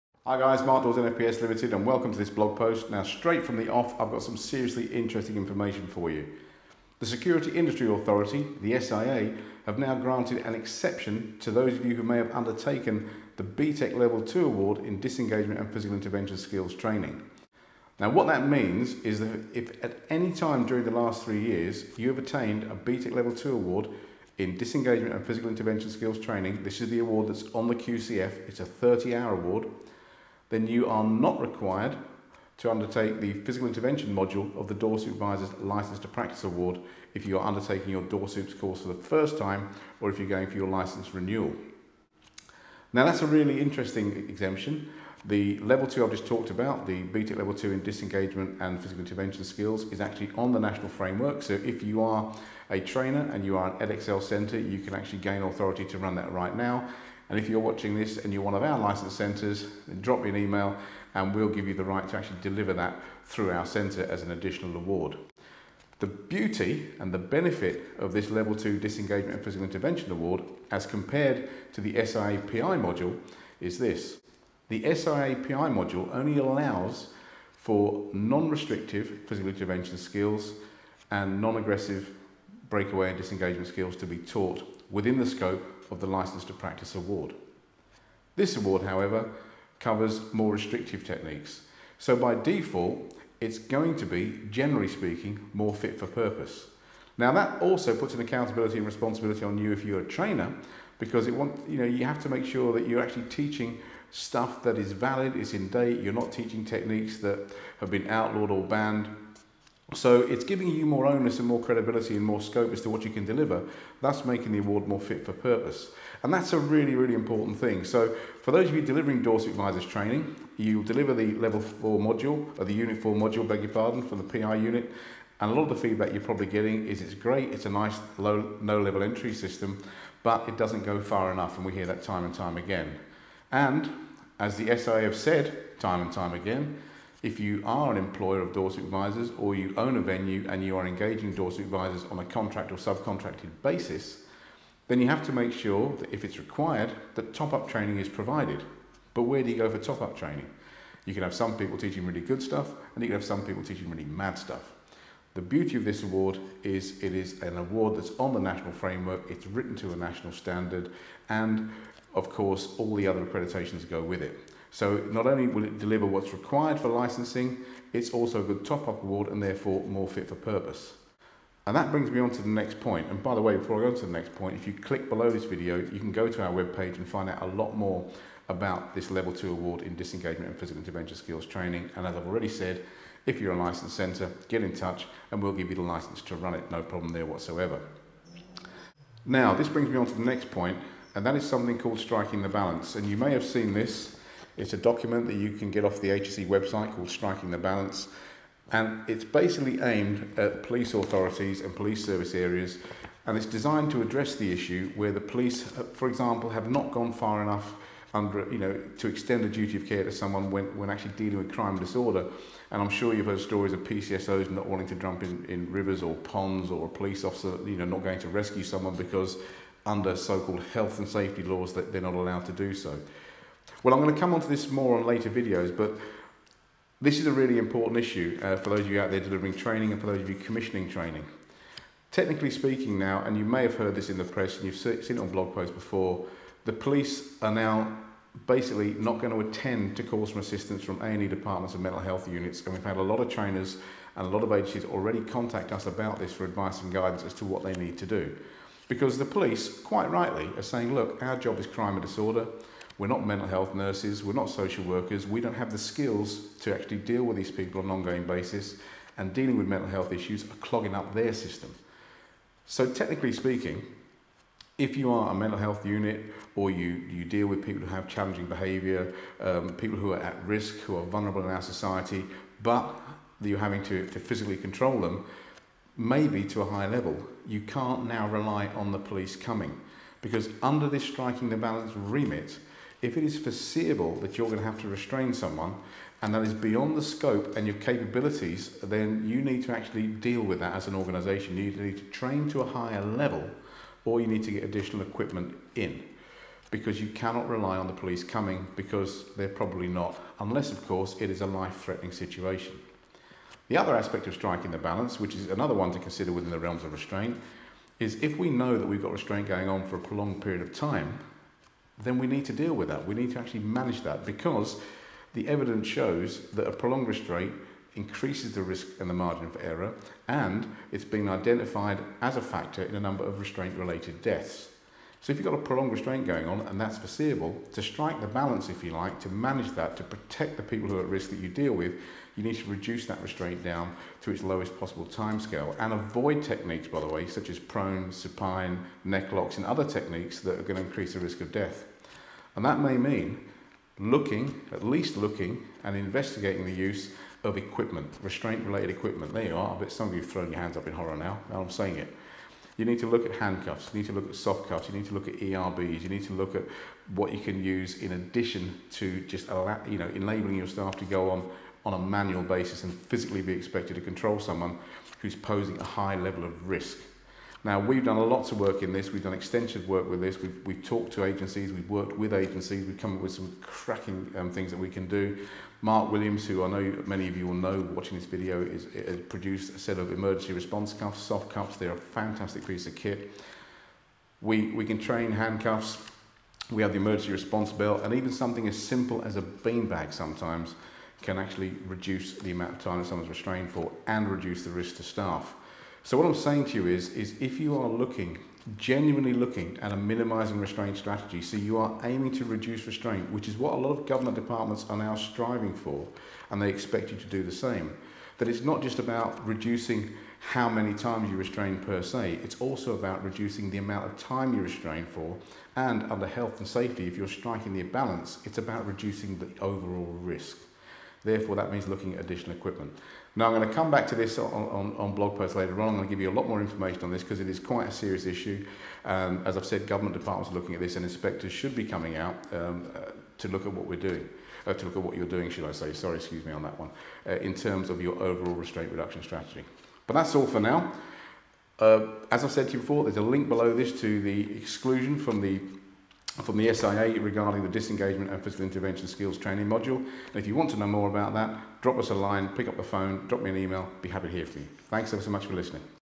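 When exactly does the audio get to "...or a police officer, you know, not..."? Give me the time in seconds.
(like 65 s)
216 s.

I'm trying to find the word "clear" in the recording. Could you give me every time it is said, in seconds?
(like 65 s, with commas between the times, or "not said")
not said.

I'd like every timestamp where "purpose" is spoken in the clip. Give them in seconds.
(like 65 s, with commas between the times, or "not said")
96 s, 115 s, 170 s.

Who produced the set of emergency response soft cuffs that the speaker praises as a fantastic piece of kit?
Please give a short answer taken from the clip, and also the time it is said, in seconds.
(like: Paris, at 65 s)
Mark Williams, at 375 s.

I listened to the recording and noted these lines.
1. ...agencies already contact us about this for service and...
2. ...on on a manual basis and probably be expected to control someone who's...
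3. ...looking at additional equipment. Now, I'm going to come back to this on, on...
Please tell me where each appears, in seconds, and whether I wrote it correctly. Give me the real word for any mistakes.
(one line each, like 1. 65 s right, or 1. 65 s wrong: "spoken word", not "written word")
1. 244 s wrong: "advice", not "service"
2. 361 s wrong: "physically", not "probably"
3. 421 s right.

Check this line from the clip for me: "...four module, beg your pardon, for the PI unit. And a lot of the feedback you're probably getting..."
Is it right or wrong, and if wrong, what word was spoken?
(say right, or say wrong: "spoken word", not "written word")
right.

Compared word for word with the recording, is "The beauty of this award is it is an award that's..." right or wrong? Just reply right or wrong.
right.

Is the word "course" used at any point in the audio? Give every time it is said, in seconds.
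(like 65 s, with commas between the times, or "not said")
38 s, 162 s, 300 s.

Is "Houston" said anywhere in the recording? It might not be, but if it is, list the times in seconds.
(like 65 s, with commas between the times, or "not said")
not said.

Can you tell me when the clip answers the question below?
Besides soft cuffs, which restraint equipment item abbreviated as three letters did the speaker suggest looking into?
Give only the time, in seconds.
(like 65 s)
355 s.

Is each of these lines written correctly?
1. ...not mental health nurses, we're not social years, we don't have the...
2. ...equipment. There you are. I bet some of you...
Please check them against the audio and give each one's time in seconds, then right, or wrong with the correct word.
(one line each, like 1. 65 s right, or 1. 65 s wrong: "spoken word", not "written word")
1. 253 s wrong: "workers", not "years"
2. 348 s right.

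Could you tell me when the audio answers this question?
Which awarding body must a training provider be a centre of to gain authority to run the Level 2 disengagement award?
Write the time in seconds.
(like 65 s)
53 s.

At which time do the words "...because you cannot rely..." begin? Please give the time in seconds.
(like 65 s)
296 s.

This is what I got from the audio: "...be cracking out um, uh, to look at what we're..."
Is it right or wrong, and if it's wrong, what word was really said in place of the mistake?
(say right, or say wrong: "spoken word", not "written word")
wrong: "coming", not "cracking".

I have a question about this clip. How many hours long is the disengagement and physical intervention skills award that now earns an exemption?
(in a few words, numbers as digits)
30.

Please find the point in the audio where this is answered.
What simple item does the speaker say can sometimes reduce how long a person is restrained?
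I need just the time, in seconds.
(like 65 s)
389 s.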